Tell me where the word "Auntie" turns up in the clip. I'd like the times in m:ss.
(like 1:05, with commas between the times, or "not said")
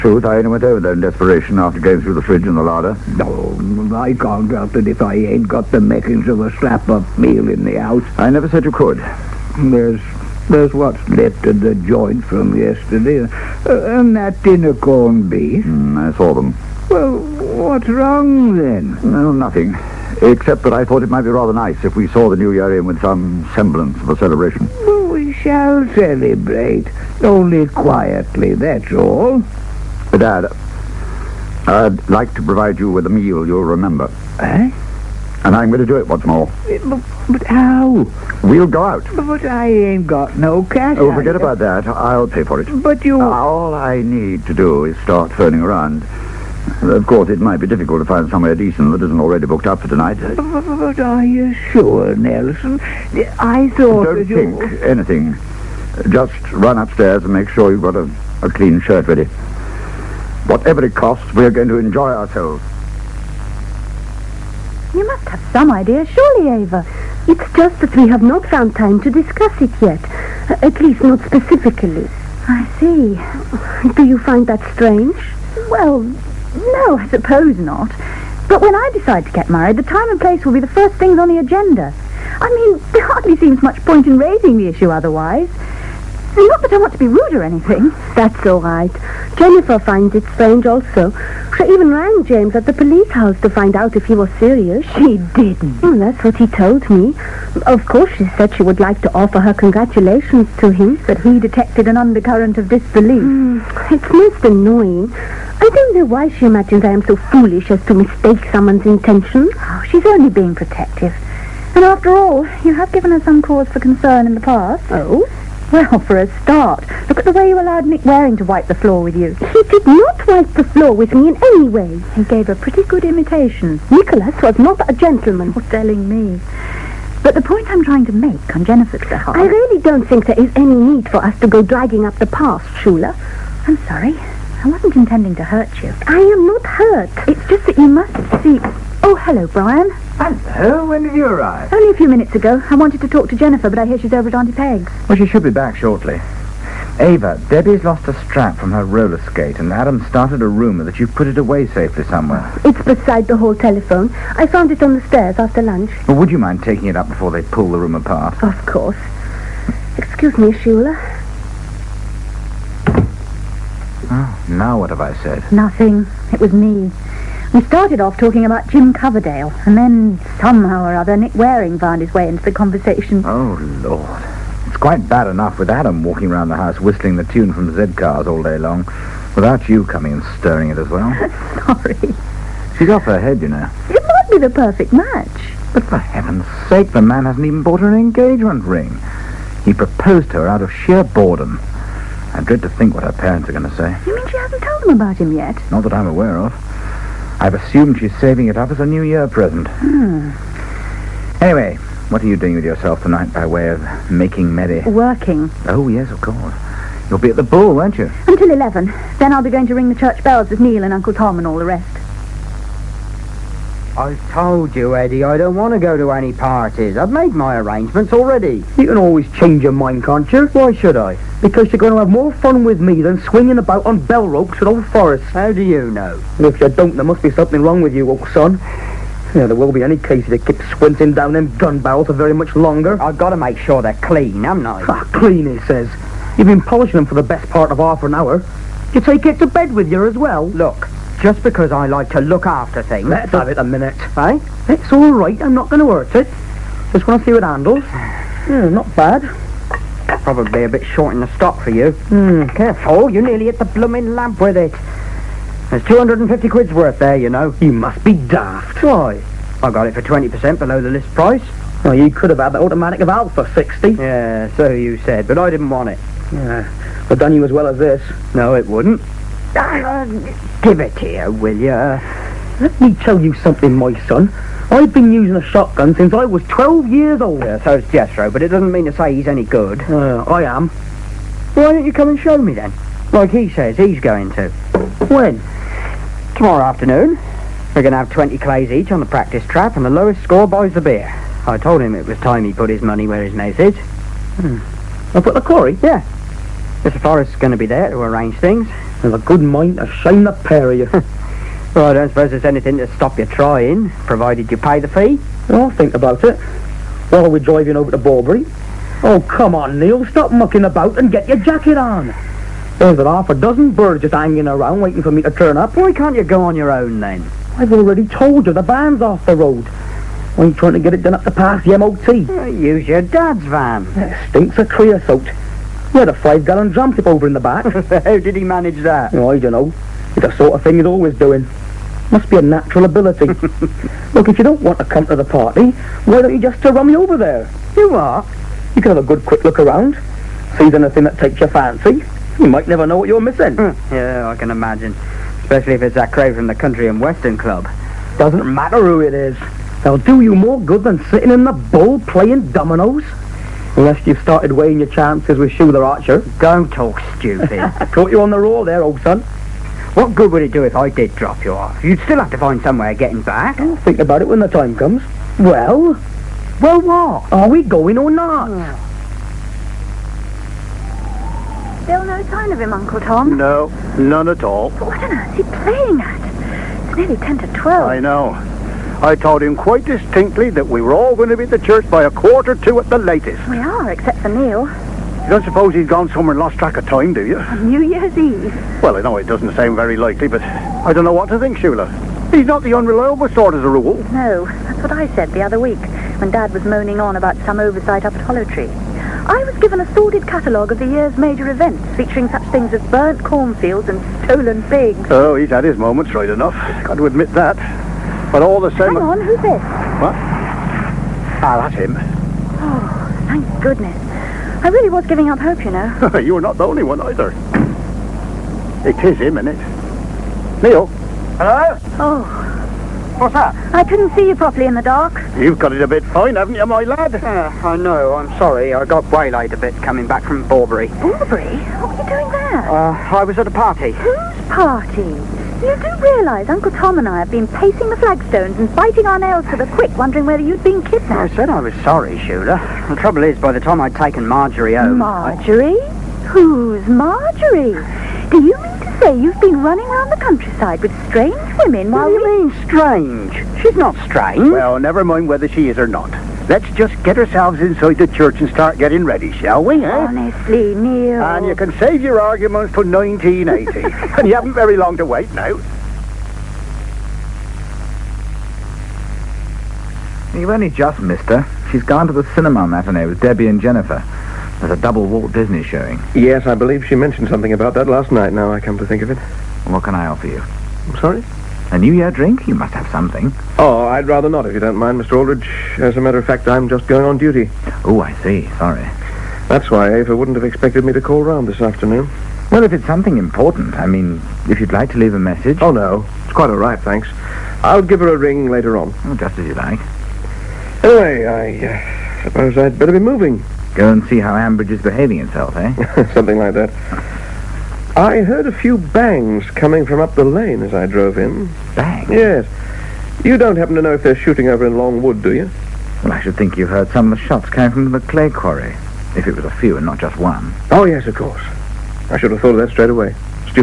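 2:24.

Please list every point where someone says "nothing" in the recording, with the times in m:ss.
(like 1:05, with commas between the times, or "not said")
0:19, 2:45.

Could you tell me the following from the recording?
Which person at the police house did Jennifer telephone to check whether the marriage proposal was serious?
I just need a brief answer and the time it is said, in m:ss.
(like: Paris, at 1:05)
James, at 1:32.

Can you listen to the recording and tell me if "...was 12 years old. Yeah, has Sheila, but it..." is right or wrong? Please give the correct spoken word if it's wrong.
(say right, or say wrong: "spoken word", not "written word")
wrong: "Jethro", not "Sheila".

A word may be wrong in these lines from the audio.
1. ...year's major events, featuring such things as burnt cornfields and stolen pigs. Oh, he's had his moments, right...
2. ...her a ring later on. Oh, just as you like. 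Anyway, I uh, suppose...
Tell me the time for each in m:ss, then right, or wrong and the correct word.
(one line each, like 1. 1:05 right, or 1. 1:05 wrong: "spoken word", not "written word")
1. 6:40 right
2. 8:17 right.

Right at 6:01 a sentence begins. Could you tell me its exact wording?
You'd still have to find somewhere getting back.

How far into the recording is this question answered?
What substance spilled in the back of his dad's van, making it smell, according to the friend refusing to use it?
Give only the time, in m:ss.
5:24.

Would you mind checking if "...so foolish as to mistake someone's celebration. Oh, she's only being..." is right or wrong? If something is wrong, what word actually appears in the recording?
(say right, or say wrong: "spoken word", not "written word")
wrong: "intention", not "celebration".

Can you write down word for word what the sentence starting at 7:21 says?
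I said I was sorry, Shula.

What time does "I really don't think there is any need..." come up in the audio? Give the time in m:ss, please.
2:09.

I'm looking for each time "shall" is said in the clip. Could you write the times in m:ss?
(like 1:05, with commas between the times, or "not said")
0:25, 7:39.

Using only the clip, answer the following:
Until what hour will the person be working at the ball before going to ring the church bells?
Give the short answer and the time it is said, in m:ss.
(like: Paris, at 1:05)
11, at 3:28.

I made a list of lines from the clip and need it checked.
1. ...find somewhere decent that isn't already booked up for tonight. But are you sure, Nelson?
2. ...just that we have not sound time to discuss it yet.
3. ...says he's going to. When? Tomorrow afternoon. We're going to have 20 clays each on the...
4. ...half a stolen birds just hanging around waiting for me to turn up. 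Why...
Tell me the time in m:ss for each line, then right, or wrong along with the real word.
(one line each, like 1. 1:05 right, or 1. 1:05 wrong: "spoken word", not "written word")
1. 0:48 right
2. 1:07 wrong: "found", not "sound"
3. 4:43 right
4. 5:12 wrong: "dozen", not "stolen".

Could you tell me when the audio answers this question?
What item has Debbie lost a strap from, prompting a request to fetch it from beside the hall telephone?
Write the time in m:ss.
2:28.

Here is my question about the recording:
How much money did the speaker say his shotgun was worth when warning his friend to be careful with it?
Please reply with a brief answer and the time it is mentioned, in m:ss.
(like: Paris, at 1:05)
250 quid, at 4:15.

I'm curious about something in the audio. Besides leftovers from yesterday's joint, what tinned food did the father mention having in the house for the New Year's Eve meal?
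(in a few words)
corned beef.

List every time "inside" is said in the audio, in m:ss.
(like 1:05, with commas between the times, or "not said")
7:37.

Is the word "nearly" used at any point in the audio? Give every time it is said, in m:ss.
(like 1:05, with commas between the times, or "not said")
4:13, 6:16.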